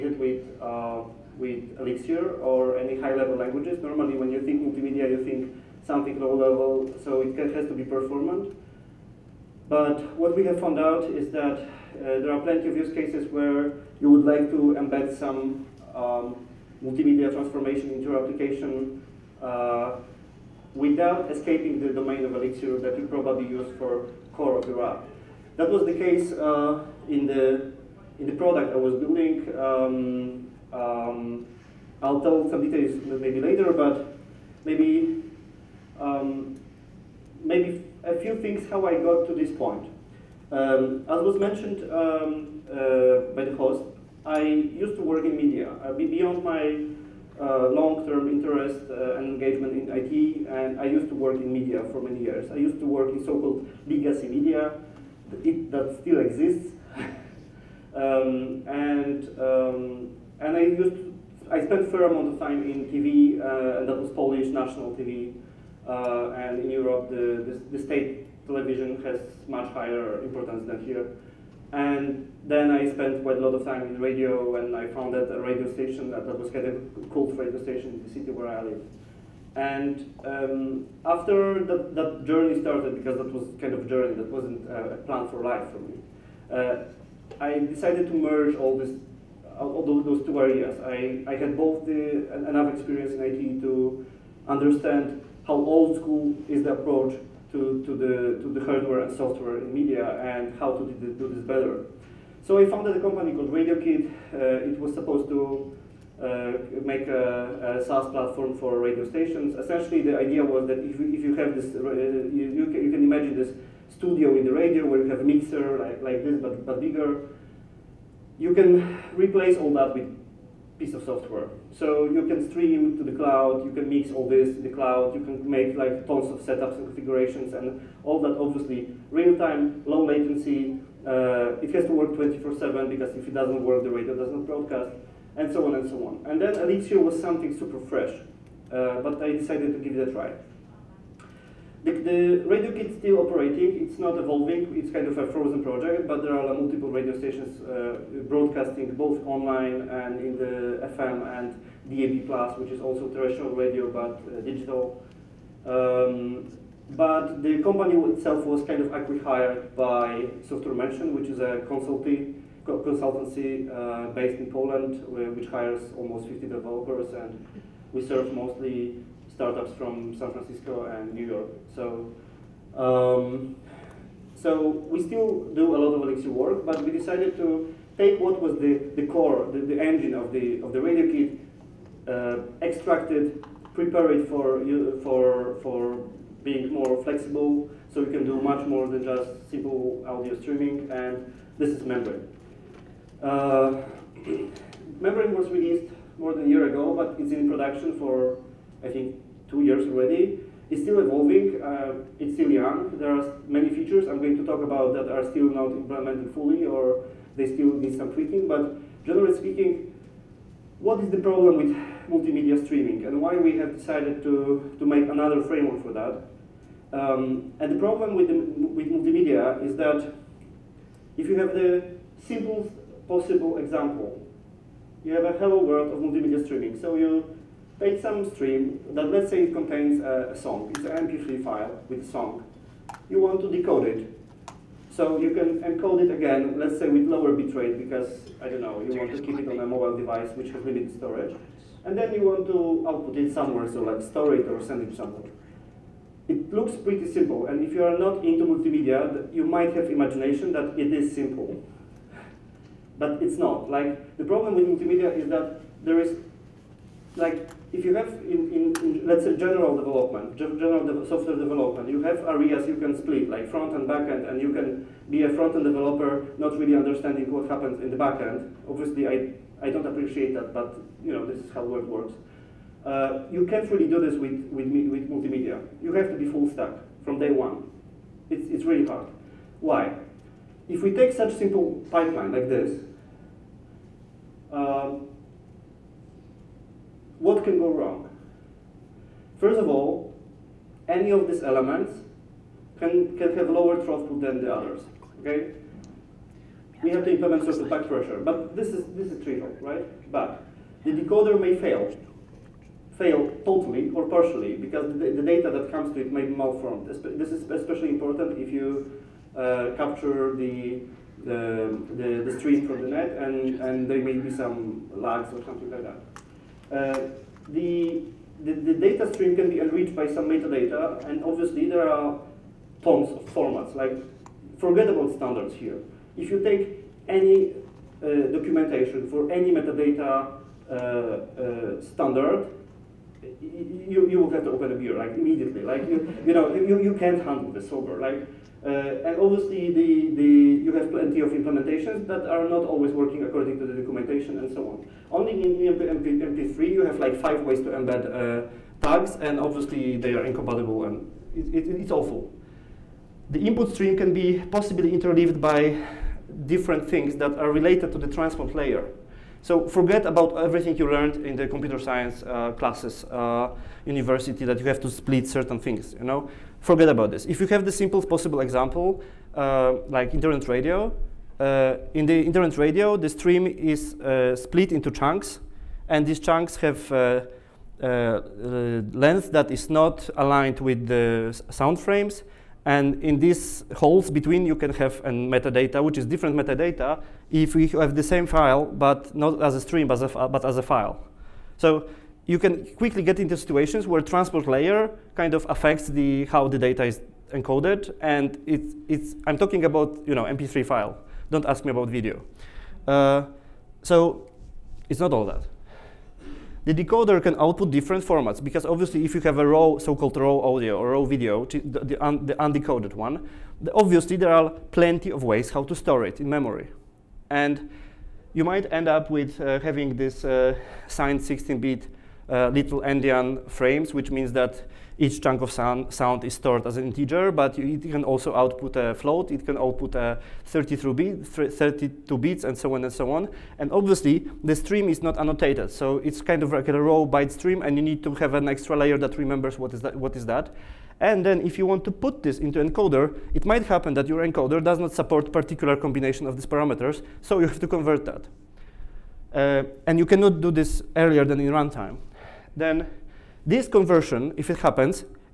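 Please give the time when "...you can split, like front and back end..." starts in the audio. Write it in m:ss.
4:22.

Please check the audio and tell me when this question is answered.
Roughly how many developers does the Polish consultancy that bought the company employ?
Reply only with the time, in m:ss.
2:45.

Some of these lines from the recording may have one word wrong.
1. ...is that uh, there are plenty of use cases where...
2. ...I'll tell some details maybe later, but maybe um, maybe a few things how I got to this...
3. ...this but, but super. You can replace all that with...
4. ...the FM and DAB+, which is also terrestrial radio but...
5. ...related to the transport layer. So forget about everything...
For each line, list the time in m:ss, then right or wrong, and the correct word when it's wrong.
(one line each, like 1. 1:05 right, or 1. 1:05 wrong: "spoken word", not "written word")
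1. 0:11 right
2. 0:32 right
3. 1:56 wrong: "bigger", not "super"
4. 2:30 right
5. 5:57 right.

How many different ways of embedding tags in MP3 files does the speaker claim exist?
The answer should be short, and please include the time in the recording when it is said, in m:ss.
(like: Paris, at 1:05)
5, at 5:47.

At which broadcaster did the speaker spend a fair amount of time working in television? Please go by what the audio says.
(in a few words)
Polish national TV.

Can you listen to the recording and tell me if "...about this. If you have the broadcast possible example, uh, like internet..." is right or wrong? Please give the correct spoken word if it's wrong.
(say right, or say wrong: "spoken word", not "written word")
wrong: "simplest", not "broadcast".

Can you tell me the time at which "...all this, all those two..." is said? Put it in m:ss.
1:28.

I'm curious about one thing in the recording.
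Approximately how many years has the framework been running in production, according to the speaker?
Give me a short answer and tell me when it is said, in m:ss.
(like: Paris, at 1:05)
2 years, at 3:19.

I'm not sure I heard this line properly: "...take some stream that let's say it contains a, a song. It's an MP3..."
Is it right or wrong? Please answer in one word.
right.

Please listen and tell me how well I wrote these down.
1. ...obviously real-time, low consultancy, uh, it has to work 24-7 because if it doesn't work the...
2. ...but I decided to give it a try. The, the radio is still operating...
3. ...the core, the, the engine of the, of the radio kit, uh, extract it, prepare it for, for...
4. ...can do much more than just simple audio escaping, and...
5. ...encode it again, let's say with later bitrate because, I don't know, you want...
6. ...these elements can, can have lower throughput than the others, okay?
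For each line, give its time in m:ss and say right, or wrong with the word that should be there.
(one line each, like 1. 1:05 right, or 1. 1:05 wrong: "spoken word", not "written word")
1. 2:08 wrong: "latency", not "consultancy"
2. 2:19 right
3. 2:58 right
4. 3:08 wrong: "streaming", not "escaping"
5. 3:55 wrong: "lower", not "later"
6. 4:51 right.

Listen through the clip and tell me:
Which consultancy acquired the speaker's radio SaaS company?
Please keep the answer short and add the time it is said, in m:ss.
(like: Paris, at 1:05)
Software Mansion, at 2:40.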